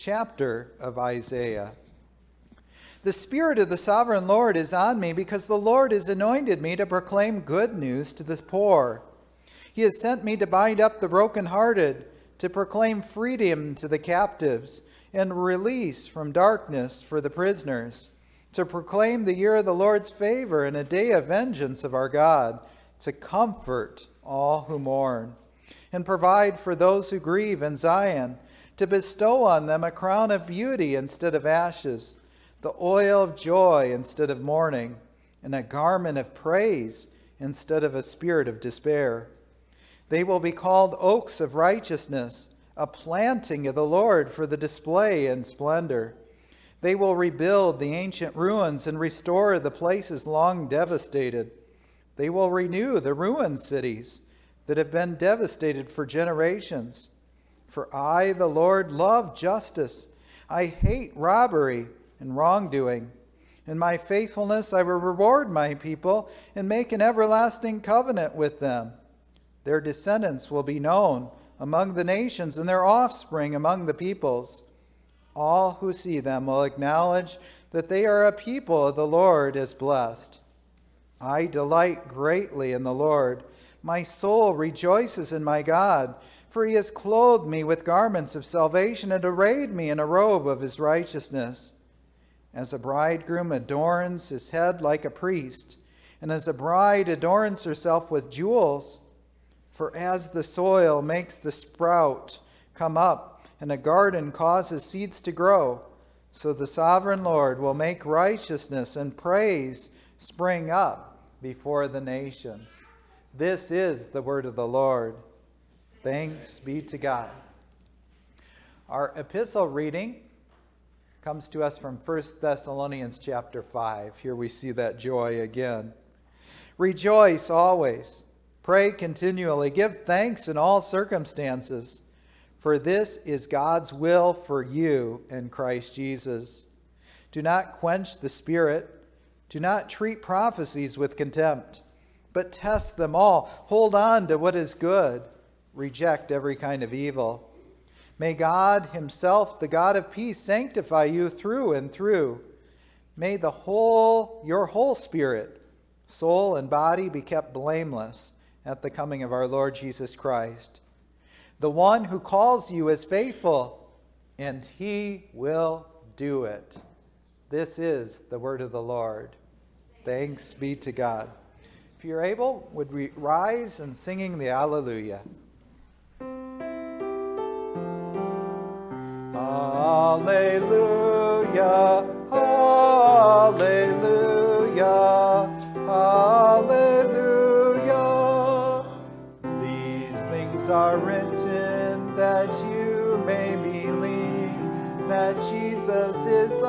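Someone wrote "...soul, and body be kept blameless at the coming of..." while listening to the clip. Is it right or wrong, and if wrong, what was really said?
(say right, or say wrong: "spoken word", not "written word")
right.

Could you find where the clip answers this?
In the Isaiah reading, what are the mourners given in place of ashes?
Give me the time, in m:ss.
0:29.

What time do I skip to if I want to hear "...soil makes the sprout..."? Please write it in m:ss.
1:40.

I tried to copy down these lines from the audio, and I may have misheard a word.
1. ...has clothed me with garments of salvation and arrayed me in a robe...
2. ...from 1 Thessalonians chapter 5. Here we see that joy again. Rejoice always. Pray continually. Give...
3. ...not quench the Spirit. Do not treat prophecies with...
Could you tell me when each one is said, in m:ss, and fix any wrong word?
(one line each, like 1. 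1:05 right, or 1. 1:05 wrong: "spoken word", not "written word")
1. 1:26 right
2. 2:01 right
3. 2:17 right.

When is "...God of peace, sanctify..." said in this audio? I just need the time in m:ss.
2:29.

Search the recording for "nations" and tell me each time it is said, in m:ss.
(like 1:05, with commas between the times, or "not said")
1:12, 1:51.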